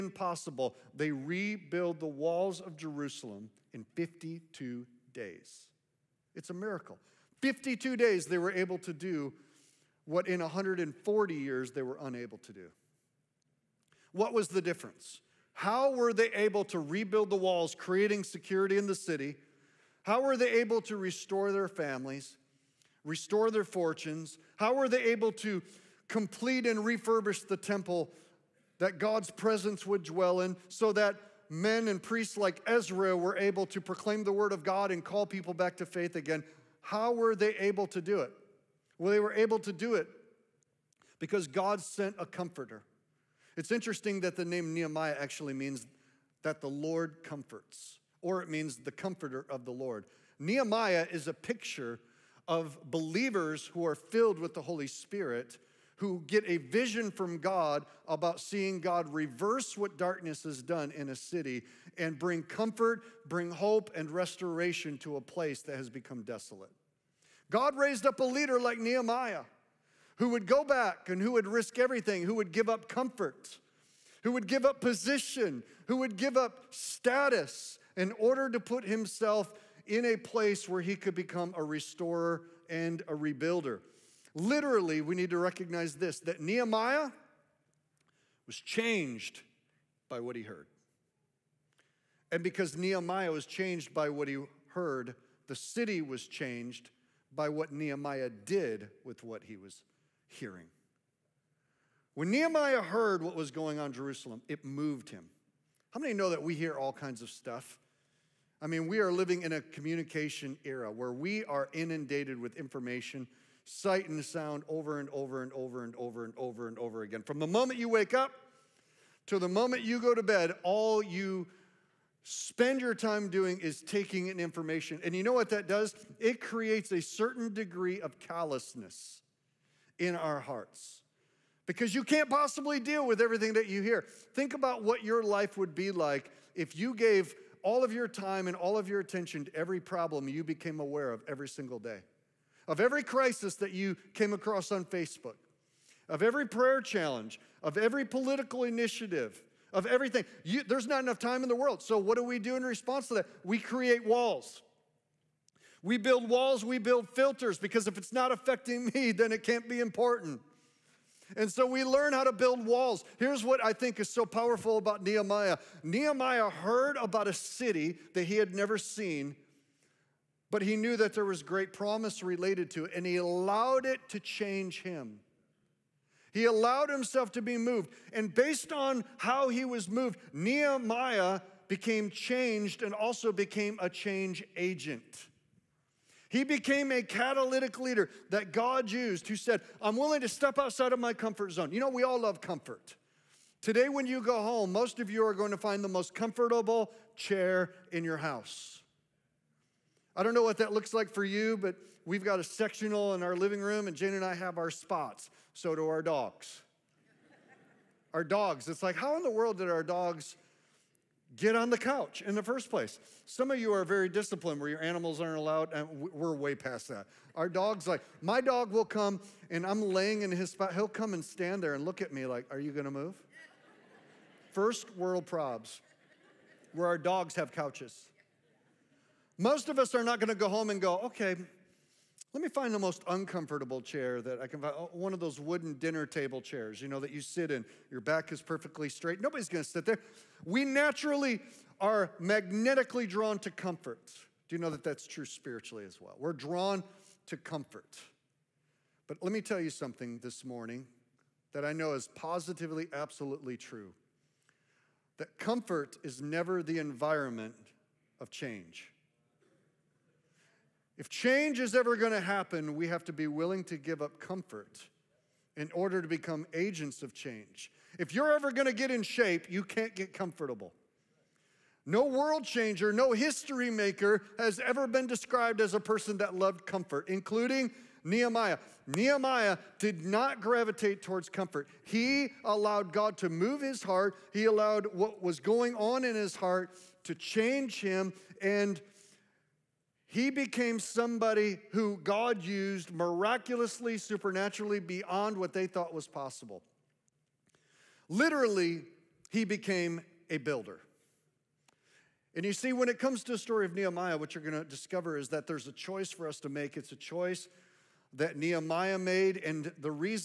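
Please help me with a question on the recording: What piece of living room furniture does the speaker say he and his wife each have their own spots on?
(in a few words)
sectional.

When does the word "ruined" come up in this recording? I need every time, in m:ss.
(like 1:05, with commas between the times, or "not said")
not said.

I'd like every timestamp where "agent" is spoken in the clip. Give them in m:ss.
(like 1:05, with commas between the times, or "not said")
3:04, 4:26.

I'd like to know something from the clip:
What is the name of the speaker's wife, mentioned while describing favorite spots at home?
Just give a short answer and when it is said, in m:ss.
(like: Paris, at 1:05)
Jane, at 3:23.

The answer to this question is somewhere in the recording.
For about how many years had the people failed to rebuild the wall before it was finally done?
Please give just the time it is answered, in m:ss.
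0:10.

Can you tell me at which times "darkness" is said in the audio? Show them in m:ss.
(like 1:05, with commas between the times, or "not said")
0:59.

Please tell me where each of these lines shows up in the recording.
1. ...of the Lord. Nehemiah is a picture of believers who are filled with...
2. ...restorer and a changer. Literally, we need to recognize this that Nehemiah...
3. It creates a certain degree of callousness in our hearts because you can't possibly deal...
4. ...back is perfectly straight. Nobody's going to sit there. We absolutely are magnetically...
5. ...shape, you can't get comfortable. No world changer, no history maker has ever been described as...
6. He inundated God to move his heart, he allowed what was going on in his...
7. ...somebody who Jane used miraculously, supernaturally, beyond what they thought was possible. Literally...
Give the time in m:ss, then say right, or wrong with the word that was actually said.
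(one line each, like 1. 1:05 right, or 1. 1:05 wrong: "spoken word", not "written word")
1. 0:49 right
2. 1:21 wrong: "rebuilder", not "changer"
3. 2:06 right
4. 3:58 wrong: "naturally", not "absolutely"
5. 4:29 right
6. 4:41 wrong: "allowed", not "inundated"
7. 4:50 wrong: "God", not "Jane".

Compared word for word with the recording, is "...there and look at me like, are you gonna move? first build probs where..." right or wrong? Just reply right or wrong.
wrong.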